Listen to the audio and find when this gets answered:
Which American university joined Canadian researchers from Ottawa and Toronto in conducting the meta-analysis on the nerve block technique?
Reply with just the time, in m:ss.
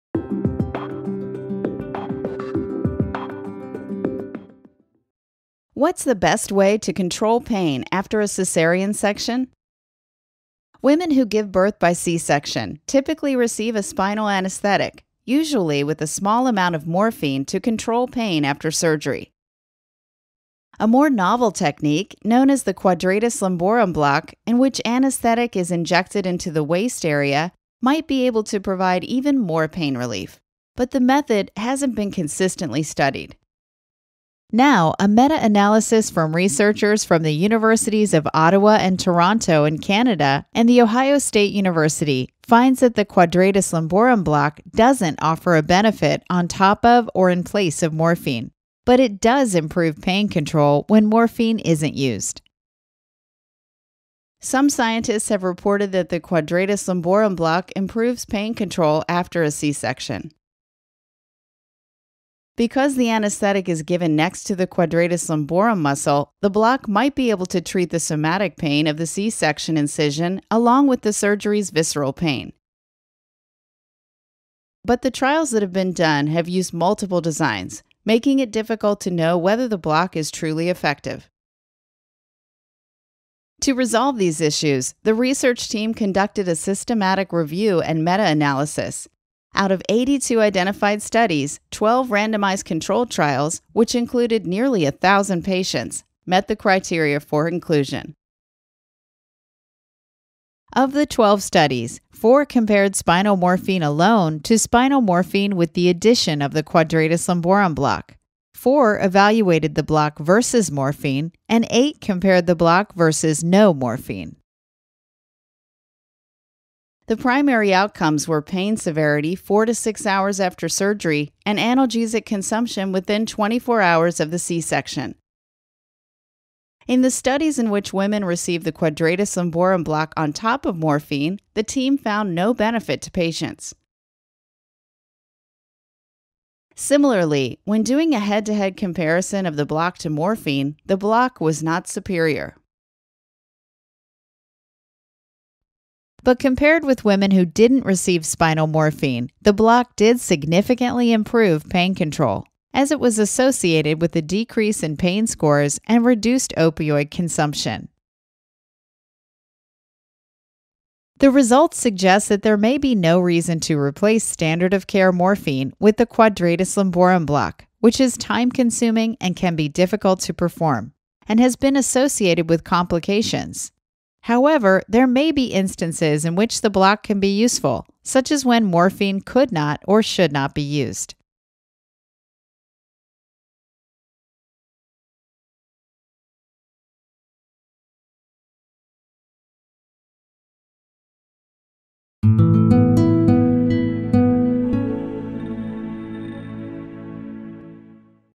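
0:40.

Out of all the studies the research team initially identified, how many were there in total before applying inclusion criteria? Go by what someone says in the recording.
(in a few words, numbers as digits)
82.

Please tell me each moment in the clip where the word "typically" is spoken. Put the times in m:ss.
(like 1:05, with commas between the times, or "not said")
0:12.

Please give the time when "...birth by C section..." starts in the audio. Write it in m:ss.
0:11.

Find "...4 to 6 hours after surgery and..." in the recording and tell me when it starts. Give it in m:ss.
1:59.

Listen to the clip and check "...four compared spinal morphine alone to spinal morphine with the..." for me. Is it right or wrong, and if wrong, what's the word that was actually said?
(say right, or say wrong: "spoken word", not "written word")
right.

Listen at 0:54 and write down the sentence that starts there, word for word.
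Some scientists have reported that the Quadratus lumborum block improves pain control after a C section.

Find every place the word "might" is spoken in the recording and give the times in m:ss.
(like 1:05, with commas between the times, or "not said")
0:27, 1:06.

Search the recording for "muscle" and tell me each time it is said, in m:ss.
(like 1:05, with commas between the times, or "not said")
1:05.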